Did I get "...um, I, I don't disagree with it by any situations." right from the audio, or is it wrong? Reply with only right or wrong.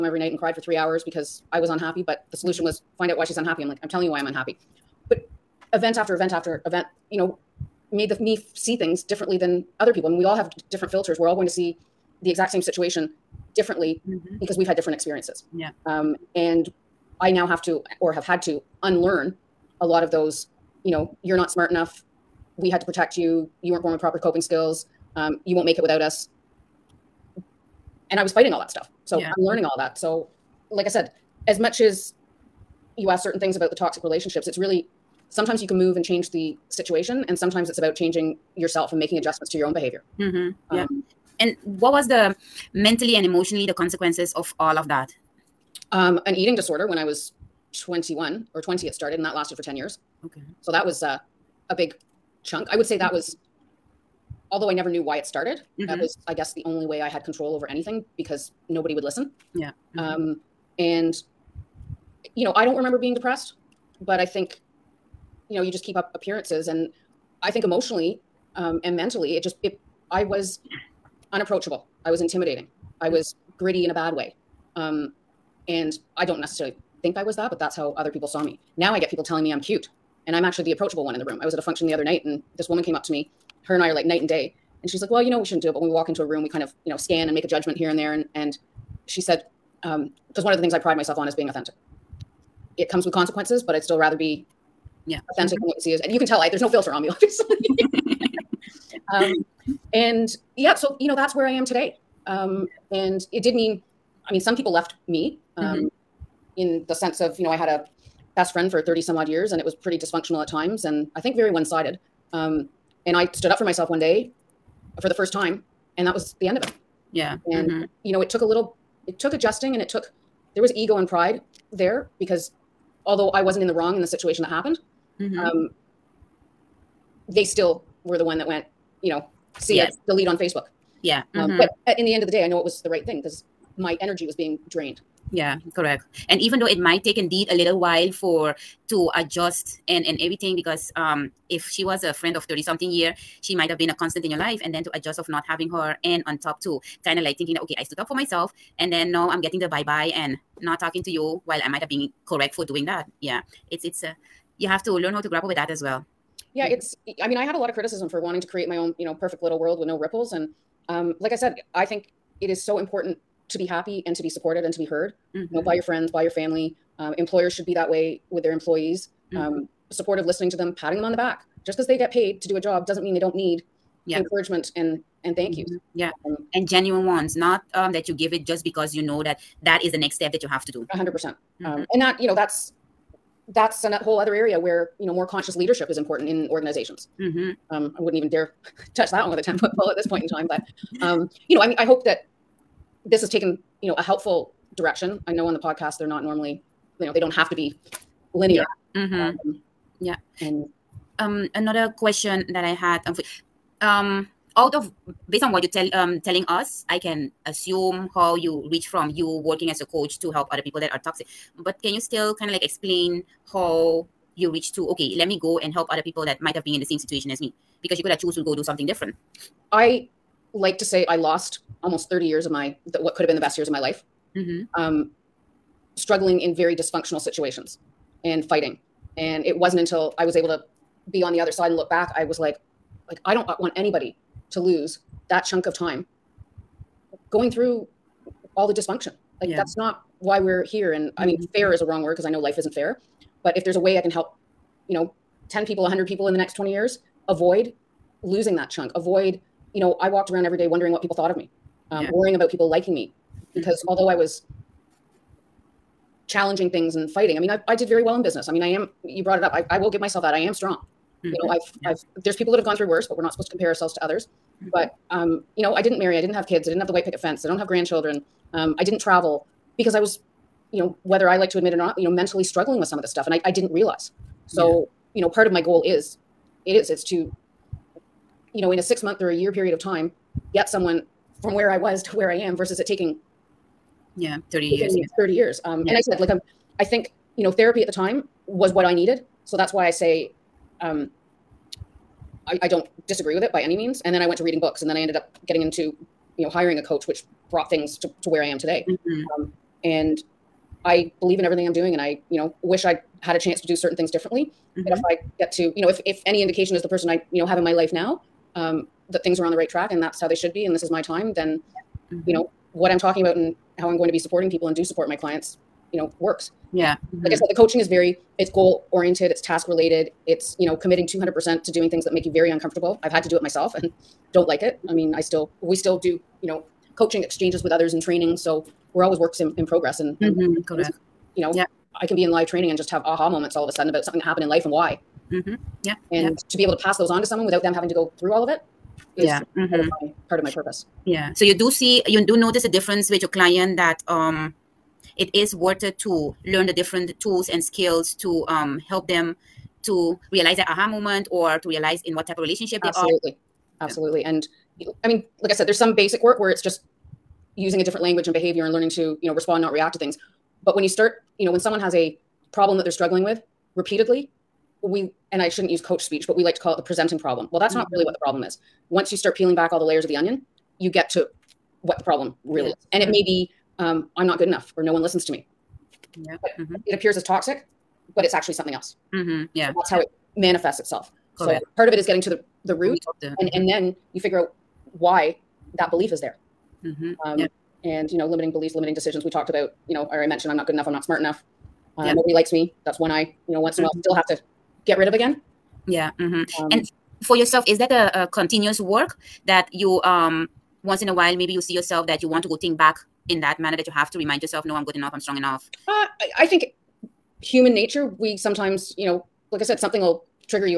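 wrong.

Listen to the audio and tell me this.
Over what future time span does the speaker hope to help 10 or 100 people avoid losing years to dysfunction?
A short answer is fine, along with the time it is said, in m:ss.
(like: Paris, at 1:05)
20 years, at 4:06.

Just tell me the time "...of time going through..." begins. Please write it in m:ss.
3:55.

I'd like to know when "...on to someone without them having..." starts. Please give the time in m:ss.
5:37.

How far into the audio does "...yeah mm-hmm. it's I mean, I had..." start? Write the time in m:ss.
2:36.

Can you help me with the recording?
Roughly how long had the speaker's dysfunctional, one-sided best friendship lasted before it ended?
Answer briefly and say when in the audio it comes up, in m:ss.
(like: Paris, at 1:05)
30-some years, at 1:48.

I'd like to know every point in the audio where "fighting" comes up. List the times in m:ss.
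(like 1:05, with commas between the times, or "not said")
0:28, 3:48, 4:17.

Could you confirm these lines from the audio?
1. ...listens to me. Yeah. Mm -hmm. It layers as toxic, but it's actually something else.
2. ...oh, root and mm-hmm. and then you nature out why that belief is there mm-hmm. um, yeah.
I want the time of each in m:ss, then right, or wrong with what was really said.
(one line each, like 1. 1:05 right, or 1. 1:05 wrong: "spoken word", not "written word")
1. 6:15 wrong: "appears", not "layers"
2. 6:22 wrong: "figure", not "nature".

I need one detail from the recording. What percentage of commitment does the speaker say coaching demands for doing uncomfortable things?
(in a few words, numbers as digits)
200%.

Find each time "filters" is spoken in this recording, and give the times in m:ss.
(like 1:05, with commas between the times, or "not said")
0:10, 1:36.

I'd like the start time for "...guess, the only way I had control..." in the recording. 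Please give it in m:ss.
0:56.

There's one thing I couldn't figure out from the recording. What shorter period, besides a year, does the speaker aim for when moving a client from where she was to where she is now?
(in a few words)
6 months.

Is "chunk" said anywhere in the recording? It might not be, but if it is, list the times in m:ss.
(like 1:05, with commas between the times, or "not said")
0:52, 3:55, 4:08.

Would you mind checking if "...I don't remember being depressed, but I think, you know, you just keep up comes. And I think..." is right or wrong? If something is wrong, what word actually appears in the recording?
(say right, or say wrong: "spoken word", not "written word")
wrong: "appearances", not "comes".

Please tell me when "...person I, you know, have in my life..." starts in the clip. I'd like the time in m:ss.
5:06.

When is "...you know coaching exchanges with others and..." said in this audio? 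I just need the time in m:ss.
5:26.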